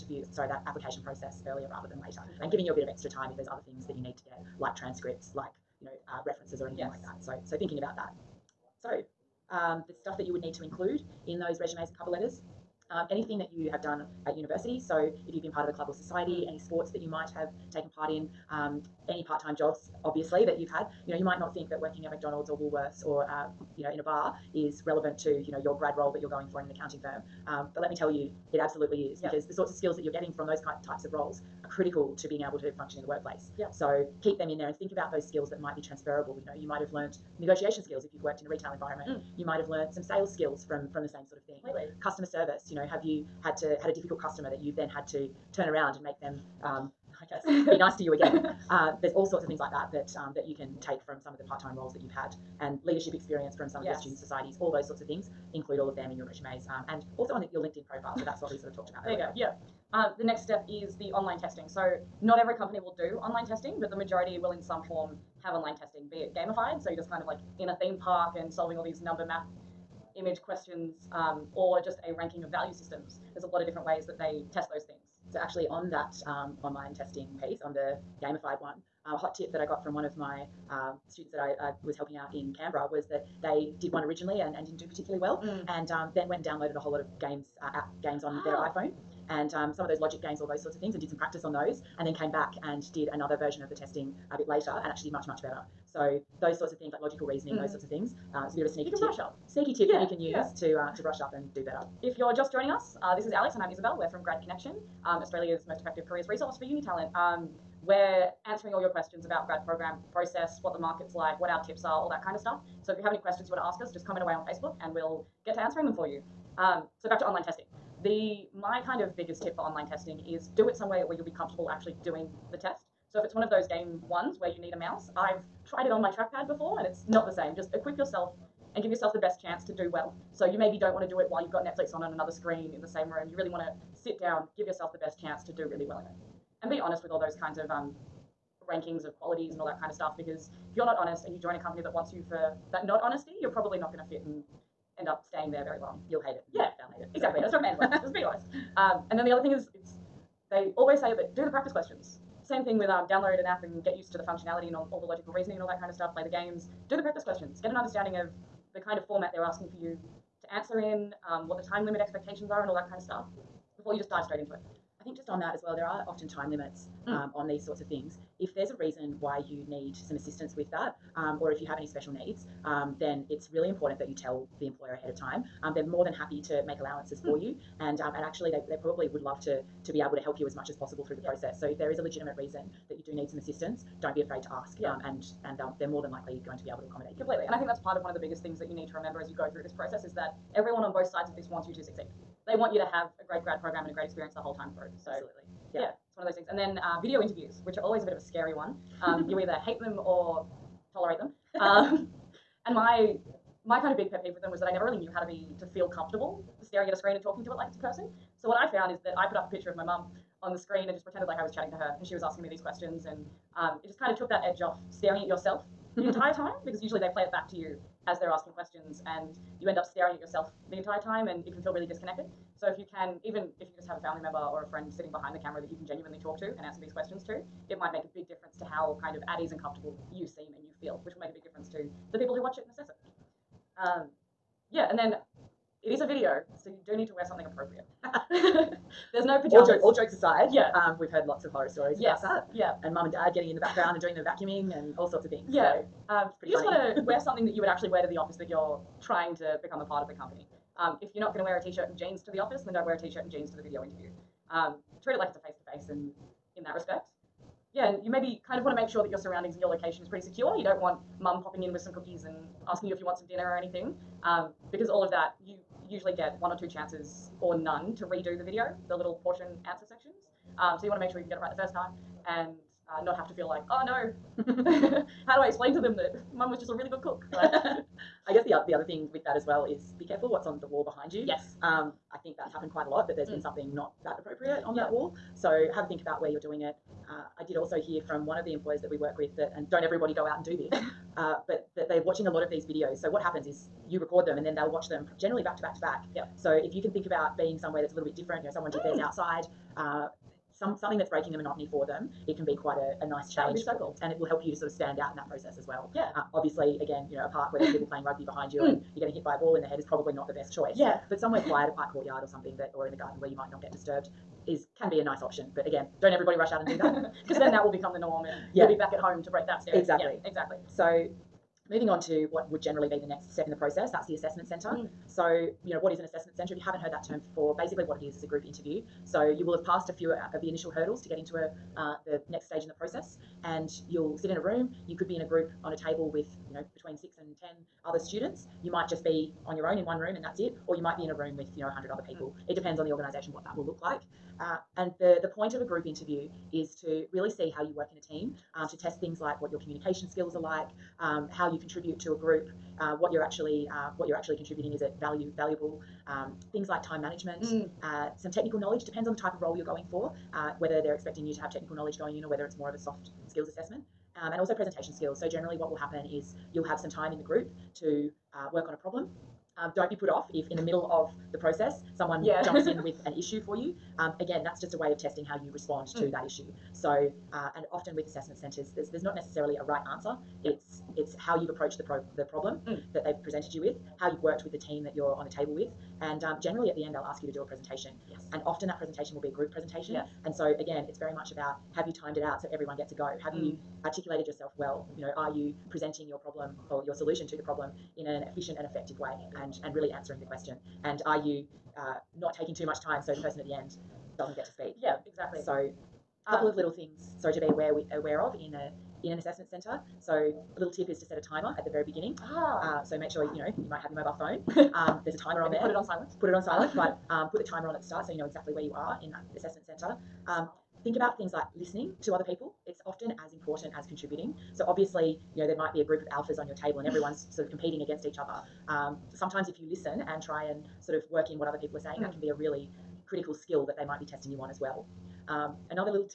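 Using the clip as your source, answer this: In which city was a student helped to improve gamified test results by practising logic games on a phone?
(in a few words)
Canberra.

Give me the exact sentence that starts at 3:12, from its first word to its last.
They want you to have a great grad program and a great experience the whole time through.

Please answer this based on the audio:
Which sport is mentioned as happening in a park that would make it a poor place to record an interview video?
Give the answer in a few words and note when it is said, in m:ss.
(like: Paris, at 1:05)
Rugby, at 5:08.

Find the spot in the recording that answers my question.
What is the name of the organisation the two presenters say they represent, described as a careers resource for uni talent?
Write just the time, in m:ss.
1:44.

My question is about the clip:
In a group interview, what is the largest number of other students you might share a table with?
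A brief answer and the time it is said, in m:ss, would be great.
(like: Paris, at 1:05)
10, at 5:37.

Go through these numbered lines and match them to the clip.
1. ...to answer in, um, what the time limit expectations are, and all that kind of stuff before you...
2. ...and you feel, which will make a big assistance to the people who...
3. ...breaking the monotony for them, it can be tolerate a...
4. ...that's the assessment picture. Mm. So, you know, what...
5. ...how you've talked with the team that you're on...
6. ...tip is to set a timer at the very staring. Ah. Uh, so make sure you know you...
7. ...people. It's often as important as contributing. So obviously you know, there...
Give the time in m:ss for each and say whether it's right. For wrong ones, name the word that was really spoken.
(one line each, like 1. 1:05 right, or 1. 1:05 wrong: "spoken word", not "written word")
1. 2:40 right
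2. 3:50 wrong: "difference", not "assistance"
3. 5:01 wrong: "quite", not "tolerate"
4. 5:23 wrong: "centre", not "picture"
5. 6:23 wrong: "worked", not "talked"
6. 6:50 wrong: "beginning", not "staring"
7. 7:02 right.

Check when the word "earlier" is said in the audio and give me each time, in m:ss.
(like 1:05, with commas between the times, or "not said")
0:01, 0:59.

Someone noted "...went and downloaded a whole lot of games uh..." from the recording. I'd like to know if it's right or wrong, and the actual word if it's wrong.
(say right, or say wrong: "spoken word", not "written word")
right.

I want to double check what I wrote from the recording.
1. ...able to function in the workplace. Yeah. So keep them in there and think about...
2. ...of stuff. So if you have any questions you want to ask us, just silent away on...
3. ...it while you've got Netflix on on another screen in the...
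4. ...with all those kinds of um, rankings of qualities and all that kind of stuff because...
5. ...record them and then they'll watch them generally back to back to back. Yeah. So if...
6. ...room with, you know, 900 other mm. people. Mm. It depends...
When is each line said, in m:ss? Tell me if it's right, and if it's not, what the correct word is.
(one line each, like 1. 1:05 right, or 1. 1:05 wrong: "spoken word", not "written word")
1. 0:32 right
2. 1:52 wrong: "comment", not "silent"
3. 2:11 right
4. 2:17 right
5. 4:53 right
6. 5:41 wrong: "100", not "900".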